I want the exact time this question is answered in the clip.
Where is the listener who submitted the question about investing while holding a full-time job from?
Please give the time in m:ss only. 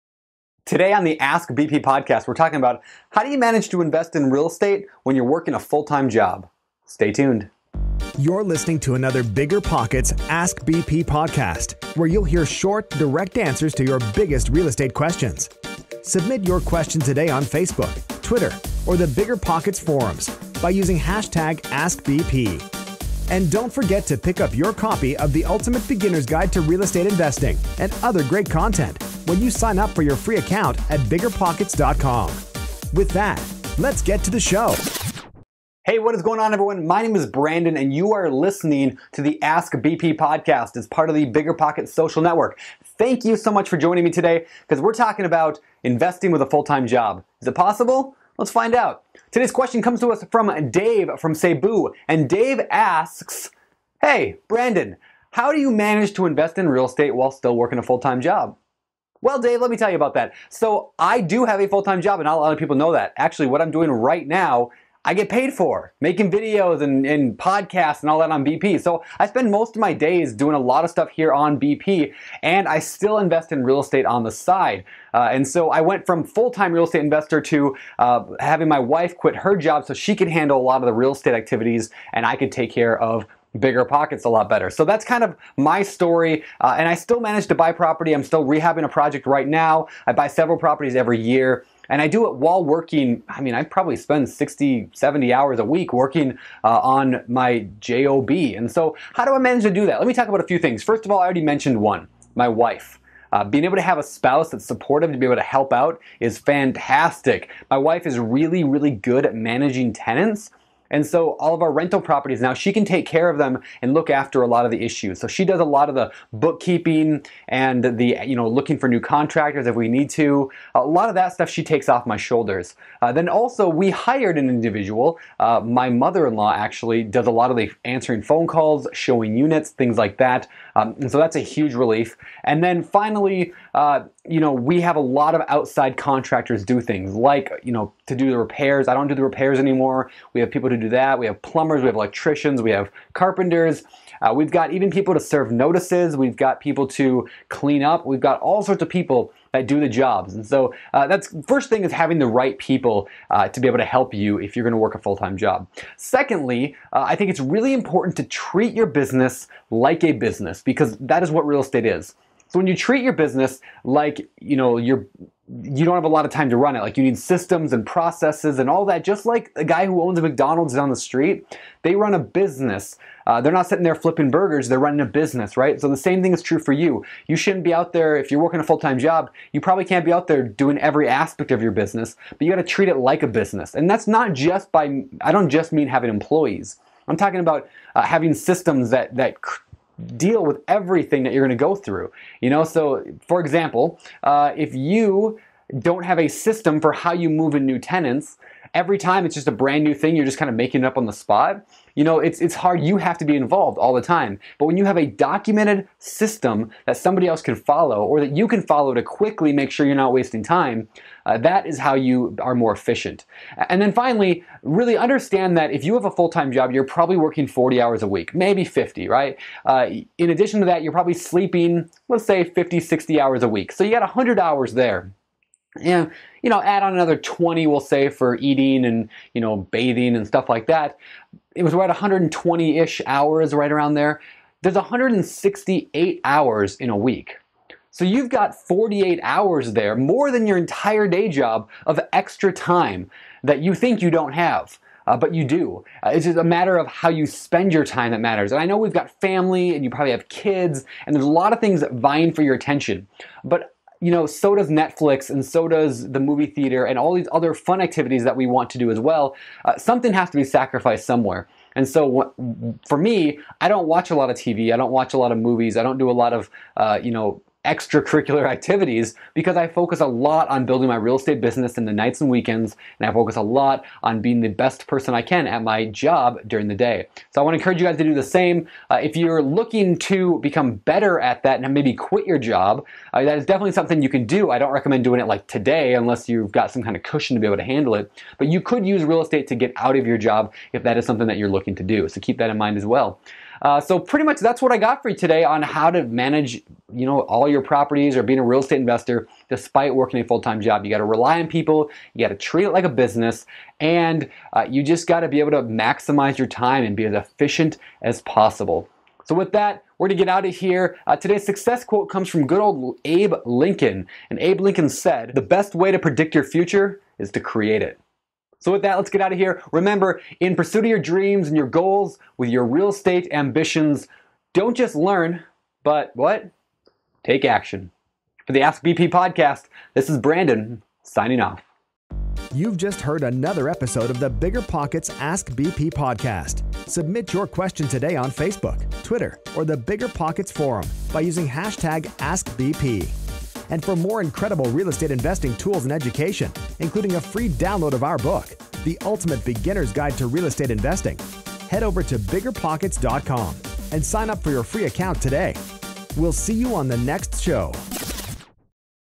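0:51.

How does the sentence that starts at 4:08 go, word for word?
And I know we've got family and you probably have kids, and there's a lot of things vying for your attention.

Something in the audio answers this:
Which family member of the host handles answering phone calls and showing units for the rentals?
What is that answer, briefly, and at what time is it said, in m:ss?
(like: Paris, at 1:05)
Mother-in-law, at 2:05.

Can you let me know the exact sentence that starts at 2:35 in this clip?
Secondly, uh, I think it's really important to treat your business like a business because that is what real estate is.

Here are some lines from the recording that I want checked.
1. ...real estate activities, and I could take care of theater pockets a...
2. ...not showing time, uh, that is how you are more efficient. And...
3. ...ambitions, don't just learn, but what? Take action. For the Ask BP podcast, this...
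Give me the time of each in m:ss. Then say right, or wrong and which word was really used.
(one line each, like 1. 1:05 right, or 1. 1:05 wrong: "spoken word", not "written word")
1. 1:20 wrong: "bigger", not "theater"
2. 3:29 wrong: "wasting", not "showing"
3. 5:23 right.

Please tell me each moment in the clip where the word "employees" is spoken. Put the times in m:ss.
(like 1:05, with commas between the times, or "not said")
3:06.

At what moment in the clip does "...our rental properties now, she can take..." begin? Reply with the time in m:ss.
1:51.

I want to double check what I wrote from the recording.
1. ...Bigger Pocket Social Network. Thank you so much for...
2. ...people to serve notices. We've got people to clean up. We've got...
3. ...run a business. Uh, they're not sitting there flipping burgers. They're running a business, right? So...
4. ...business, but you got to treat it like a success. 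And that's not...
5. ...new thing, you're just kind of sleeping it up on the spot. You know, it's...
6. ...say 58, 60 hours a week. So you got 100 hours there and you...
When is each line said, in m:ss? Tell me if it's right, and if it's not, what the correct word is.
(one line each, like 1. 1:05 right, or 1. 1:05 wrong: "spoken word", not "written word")
1. 0:41 right
2. 2:24 right
3. 2:51 right
4. 3:01 wrong: "business", not "success"
5. 3:19 wrong: "making", not "sleeping"
6. 3:42 wrong: "50", not "58".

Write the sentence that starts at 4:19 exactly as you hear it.
Uh, something has to be sacrificed somewhere.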